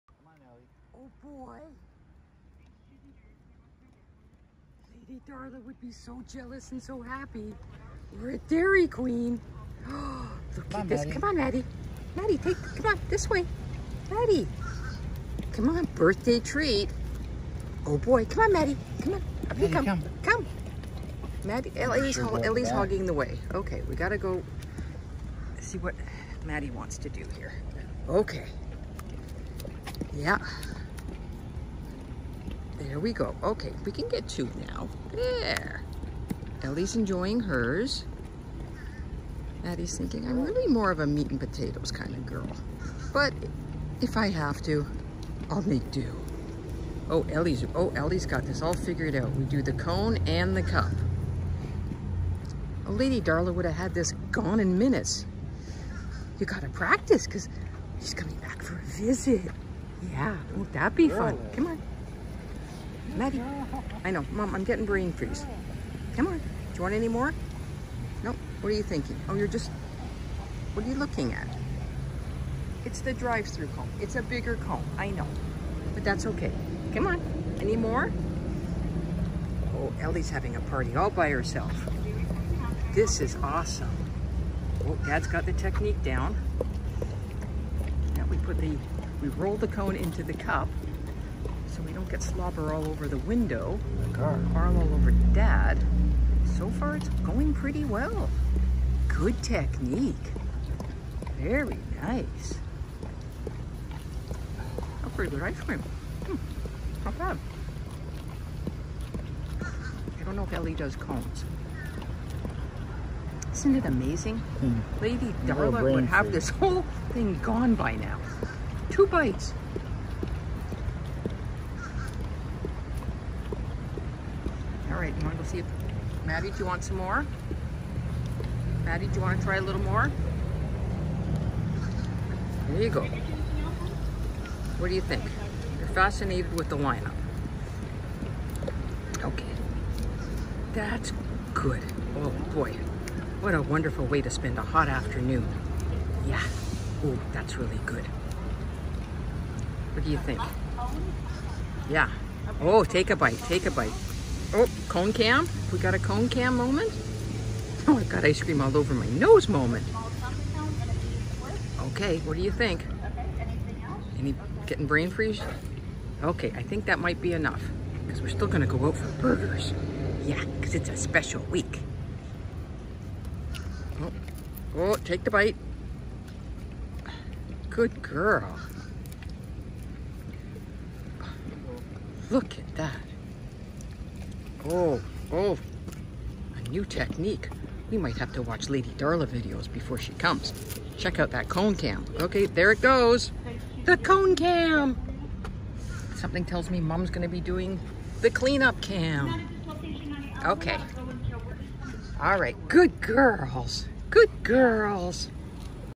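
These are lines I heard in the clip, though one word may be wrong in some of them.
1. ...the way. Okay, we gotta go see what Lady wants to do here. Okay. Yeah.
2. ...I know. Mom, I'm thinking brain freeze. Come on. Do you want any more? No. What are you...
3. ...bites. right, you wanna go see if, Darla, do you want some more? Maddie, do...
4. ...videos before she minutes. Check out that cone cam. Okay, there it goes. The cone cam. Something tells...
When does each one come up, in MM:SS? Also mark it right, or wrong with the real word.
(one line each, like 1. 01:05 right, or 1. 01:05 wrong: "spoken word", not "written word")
1. 00:23 wrong: "Maddie", not "Lady"
2. 01:04 wrong: "getting", not "thinking"
3. 01:59 wrong: "Maddie", not "Darla"
4. 03:09 wrong: "comes", not "minutes".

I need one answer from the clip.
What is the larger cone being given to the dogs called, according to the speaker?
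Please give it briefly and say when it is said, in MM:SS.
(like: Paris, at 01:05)
drive-through cone, at 01:13.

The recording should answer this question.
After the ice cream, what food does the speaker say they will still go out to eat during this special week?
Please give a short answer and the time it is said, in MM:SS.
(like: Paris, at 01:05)
burgers, at 02:49.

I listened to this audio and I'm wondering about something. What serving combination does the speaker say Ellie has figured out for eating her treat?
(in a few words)
the cone and the cup.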